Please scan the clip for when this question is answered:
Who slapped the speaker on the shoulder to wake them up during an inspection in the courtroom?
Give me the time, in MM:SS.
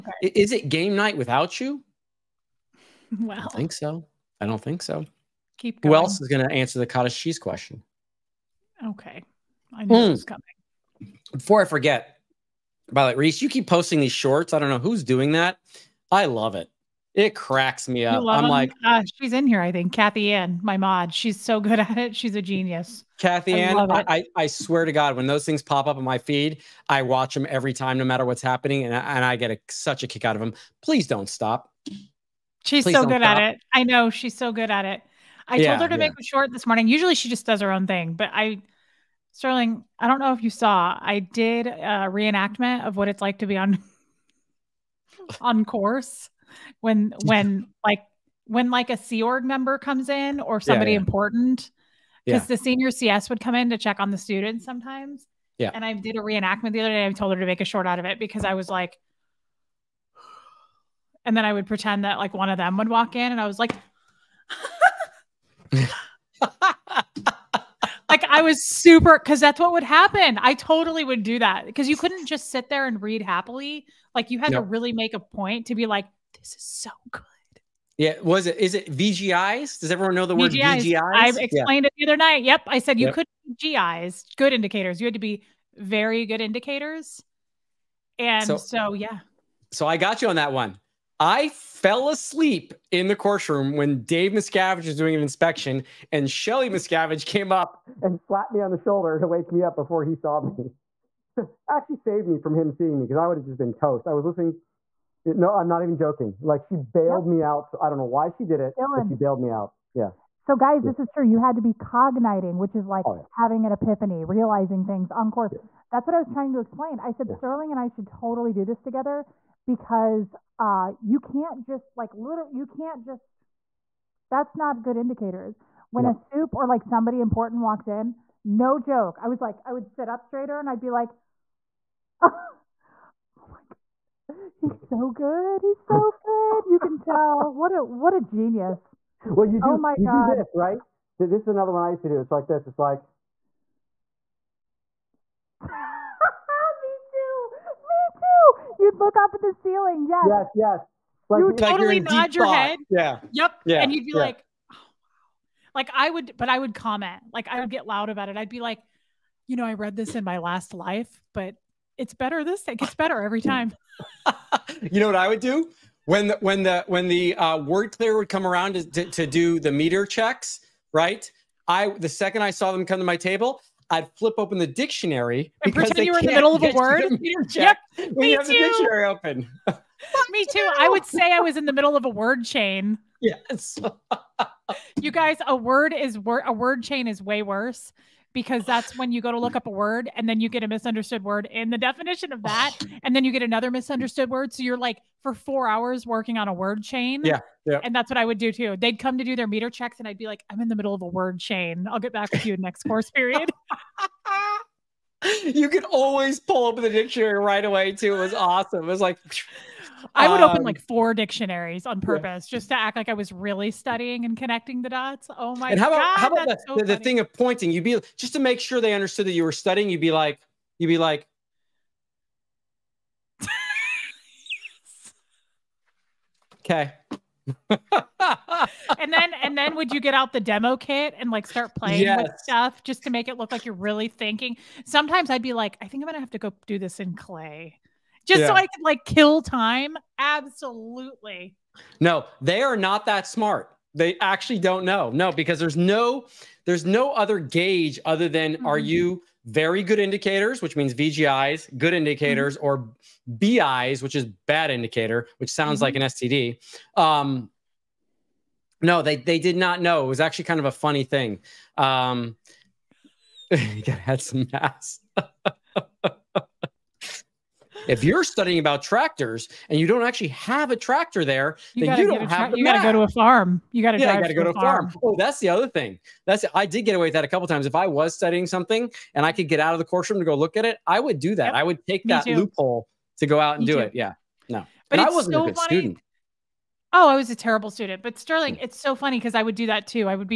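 01:36.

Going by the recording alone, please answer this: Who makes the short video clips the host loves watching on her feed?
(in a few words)
Kathy Ann.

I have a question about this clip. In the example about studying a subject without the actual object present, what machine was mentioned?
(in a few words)
tractor.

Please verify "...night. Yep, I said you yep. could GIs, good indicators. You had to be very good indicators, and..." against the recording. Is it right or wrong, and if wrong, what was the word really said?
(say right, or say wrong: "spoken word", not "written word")
right.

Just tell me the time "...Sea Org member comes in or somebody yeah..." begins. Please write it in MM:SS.
00:48.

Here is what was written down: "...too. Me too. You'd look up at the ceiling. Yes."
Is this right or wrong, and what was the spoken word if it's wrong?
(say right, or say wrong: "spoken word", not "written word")
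right.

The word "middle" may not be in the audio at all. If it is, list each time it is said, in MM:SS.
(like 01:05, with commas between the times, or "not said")
02:56, 03:01, 03:20.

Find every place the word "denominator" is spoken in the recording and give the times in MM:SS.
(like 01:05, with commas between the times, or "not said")
not said.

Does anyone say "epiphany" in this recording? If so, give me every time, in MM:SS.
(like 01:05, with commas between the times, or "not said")
01:53.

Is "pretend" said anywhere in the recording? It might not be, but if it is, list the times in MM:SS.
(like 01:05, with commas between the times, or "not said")
01:01, 02:55.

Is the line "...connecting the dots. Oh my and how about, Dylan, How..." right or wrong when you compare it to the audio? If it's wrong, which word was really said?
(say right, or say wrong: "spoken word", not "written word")
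wrong: "God", not "Dylan".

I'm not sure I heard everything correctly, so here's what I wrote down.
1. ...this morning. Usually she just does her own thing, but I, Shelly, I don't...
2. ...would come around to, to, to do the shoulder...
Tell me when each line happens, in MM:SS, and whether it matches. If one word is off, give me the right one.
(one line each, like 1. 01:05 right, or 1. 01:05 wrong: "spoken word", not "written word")
1. 00:36 wrong: "Sterling", not "Shelly"
2. 02:48 wrong: "meter", not "shoulder".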